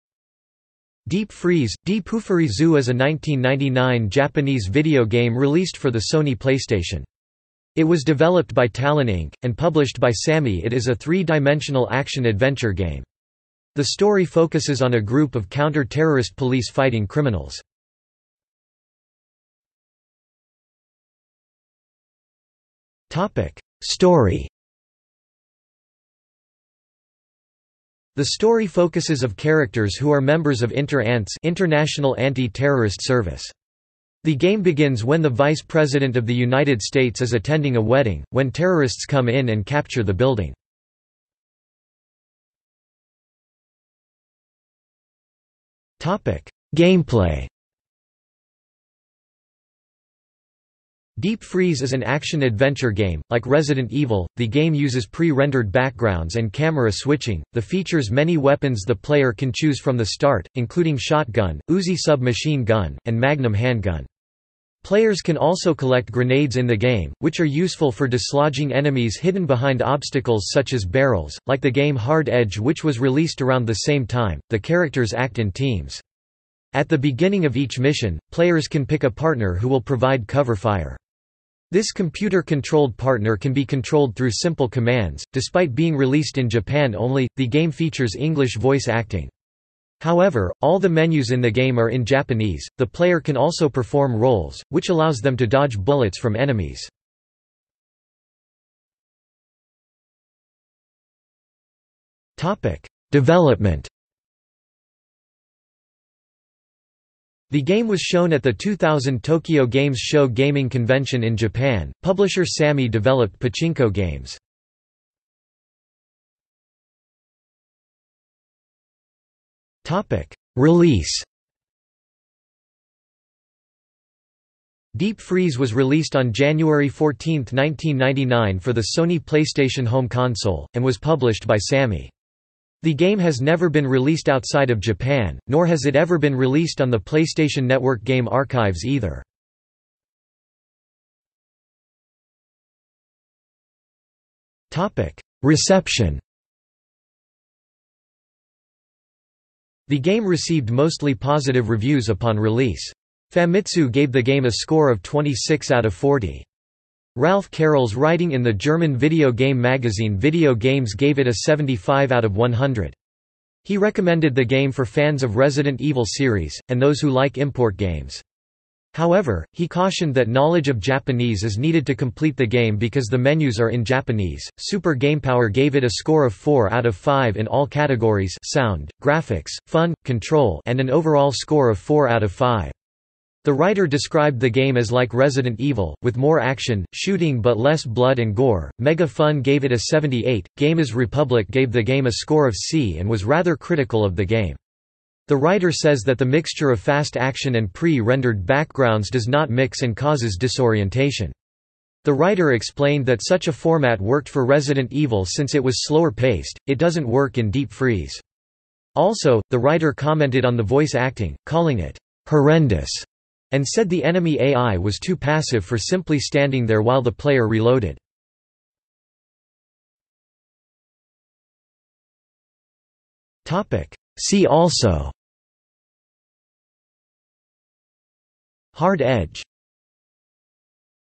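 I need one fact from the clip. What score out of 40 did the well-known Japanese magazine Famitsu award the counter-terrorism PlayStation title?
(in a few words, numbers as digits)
26.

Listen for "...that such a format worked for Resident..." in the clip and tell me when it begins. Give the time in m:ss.
3:23.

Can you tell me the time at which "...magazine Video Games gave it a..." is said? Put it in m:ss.
2:39.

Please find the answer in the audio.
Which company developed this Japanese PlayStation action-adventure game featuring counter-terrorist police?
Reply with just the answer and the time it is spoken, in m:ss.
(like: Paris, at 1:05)
Talon Inc., at 0:08.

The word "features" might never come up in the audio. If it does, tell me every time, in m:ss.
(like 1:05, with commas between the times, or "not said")
0:57, 1:27.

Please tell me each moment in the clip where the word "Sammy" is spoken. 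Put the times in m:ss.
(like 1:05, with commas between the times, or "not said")
0:10, 1:52, 2:11.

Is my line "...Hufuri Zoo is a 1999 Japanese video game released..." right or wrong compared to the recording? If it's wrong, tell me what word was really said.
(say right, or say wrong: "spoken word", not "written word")
right.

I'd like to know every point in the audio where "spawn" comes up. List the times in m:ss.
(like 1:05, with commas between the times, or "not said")
not said.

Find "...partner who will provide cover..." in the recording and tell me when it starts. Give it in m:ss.
1:19.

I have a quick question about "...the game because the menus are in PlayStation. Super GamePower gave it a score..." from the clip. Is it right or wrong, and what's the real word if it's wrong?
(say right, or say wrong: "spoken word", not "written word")
wrong: "Japanese", not "PlayStation".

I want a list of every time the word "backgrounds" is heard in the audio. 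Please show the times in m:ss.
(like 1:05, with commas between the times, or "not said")
0:55, 3:18.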